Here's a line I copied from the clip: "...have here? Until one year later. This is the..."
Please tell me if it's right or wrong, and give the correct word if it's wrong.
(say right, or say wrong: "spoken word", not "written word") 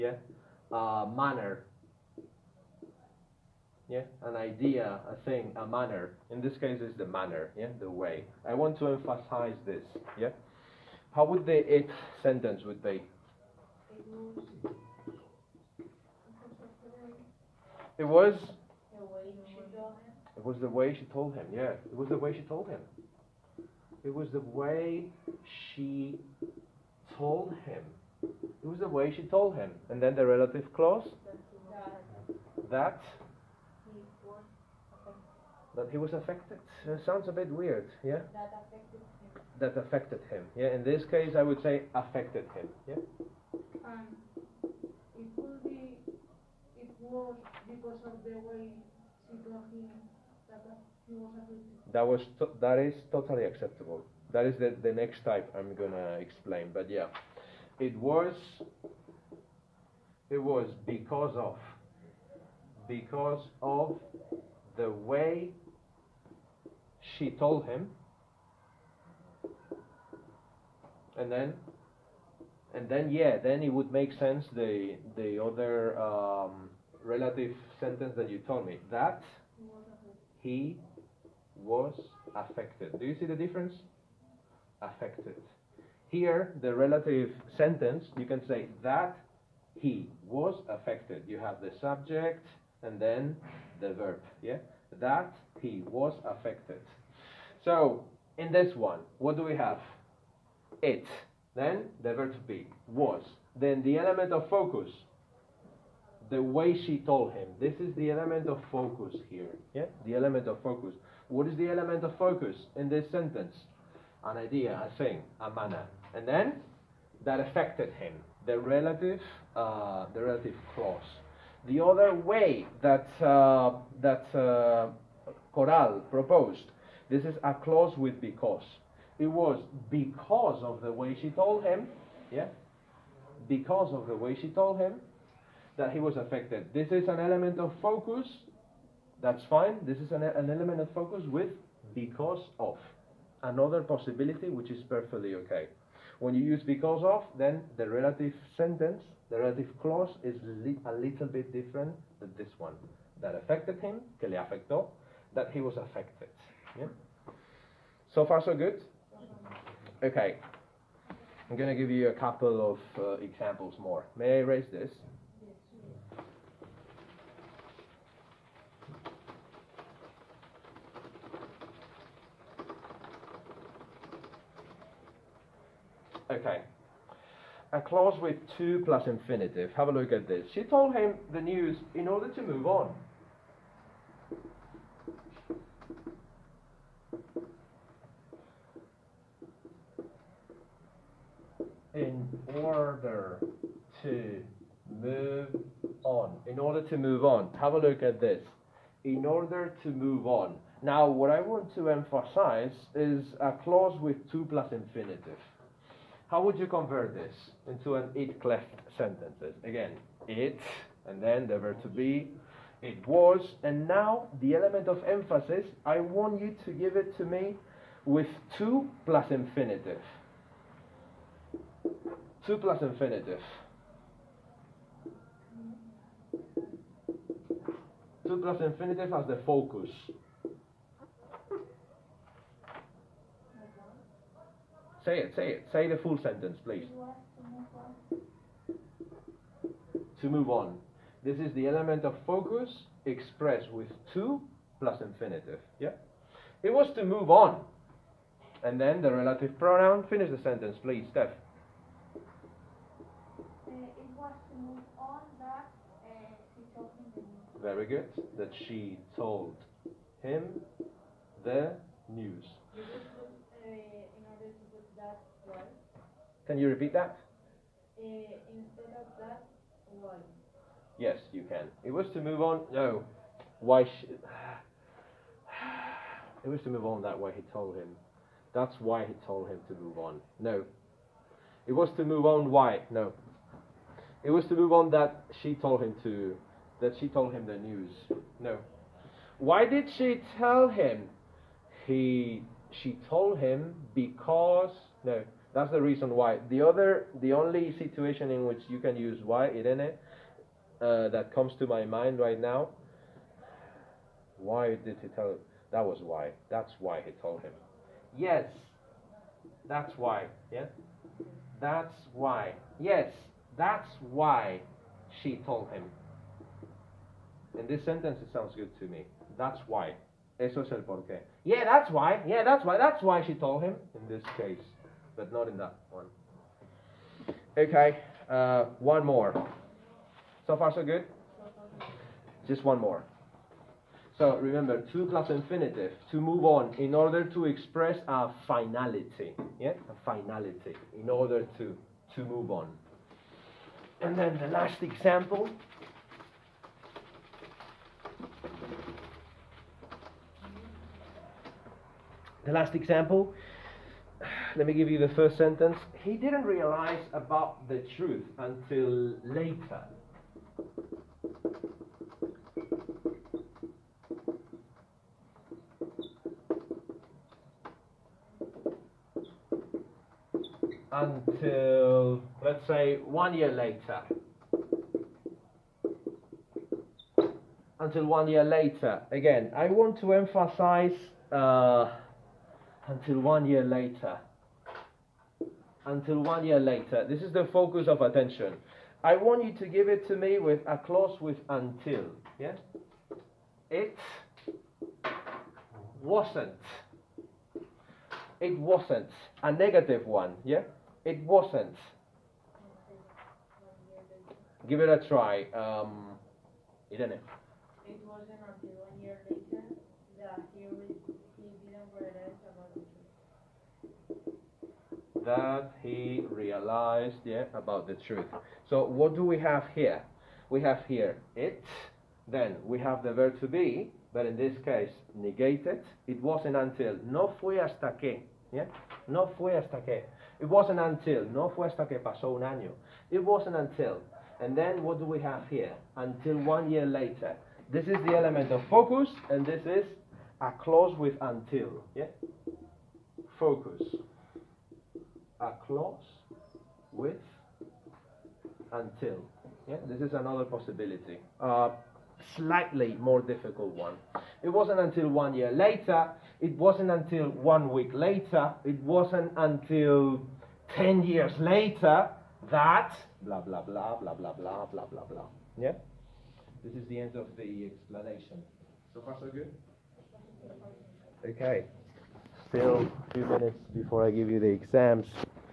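right.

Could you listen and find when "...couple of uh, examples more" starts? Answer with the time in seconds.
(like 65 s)
162 s.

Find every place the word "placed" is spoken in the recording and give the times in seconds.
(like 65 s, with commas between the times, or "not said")
not said.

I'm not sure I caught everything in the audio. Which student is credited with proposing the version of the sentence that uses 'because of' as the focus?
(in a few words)
Coral.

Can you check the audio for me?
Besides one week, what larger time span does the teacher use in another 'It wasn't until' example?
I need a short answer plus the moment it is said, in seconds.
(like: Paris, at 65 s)
10 years, at 460 s.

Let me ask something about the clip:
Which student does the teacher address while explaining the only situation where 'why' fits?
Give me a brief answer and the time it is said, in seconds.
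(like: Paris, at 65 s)
Irene, at 299 s.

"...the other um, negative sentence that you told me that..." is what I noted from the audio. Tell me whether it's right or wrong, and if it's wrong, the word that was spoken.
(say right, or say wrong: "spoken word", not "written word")
wrong: "relative", not "negative".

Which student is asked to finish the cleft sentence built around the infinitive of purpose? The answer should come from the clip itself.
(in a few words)
Steph.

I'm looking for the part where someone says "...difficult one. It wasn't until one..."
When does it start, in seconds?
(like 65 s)
453 s.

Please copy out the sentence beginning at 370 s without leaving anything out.
Until, let's say, one year later.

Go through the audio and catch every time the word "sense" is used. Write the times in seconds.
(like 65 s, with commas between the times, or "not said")
74 s.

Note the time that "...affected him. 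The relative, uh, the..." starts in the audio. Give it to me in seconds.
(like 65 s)
117 s.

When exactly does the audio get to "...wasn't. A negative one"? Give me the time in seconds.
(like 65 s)
398 s.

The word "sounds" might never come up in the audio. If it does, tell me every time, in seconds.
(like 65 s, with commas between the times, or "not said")
37 s, 318 s.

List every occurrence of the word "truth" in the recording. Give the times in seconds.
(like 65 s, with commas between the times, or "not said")
357 s, 418 s.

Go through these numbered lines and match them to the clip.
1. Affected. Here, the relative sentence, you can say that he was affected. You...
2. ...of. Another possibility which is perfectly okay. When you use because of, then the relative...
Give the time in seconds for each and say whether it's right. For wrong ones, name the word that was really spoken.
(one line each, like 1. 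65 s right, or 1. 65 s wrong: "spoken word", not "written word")
1. 84 s right
2. 142 s right.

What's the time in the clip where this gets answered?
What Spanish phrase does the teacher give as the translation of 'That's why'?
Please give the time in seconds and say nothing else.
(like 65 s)
320 s.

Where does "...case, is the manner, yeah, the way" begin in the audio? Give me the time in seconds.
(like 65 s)
6 s.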